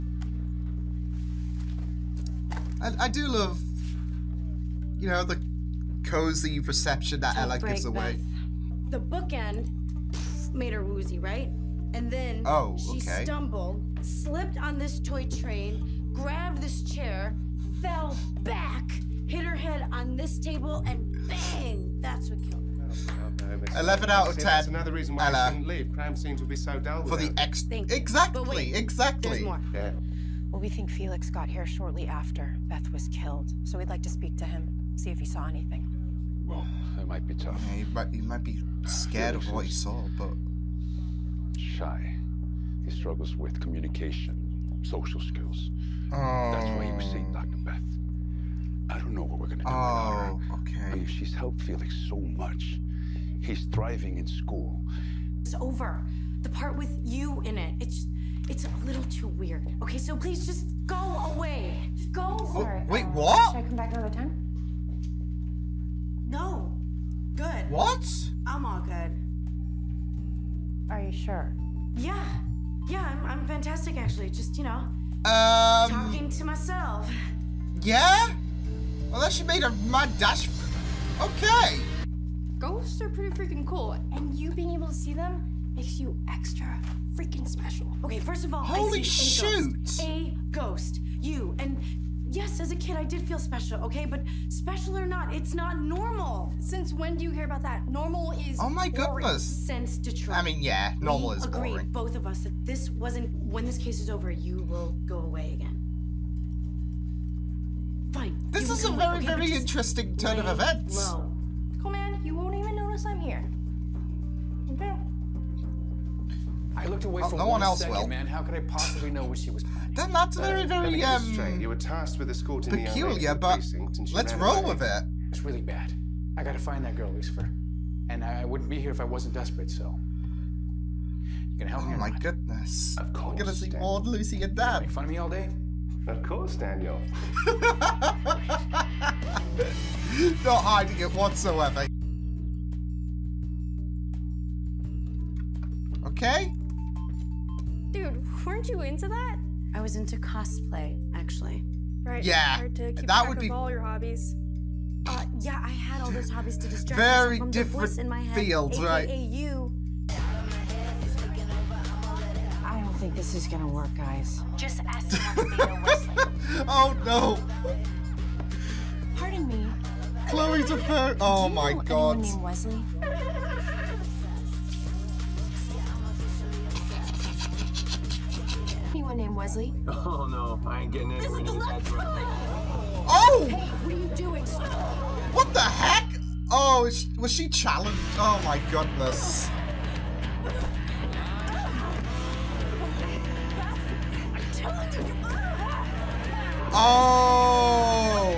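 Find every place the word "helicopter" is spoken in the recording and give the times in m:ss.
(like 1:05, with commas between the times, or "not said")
not said.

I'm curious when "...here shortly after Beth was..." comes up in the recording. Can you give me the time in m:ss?
0:31.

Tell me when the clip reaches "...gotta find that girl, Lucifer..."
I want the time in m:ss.
2:06.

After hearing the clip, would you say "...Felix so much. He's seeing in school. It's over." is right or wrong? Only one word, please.
wrong.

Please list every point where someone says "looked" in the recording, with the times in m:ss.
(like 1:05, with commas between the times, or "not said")
1:56.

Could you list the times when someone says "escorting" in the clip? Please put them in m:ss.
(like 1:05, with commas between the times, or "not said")
2:02.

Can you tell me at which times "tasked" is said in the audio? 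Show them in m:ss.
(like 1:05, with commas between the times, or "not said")
2:01.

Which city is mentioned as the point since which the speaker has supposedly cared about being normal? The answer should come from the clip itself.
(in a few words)
Detroit.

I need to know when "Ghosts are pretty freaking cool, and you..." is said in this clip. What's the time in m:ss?
1:22.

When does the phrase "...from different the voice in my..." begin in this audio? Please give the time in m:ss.
2:37.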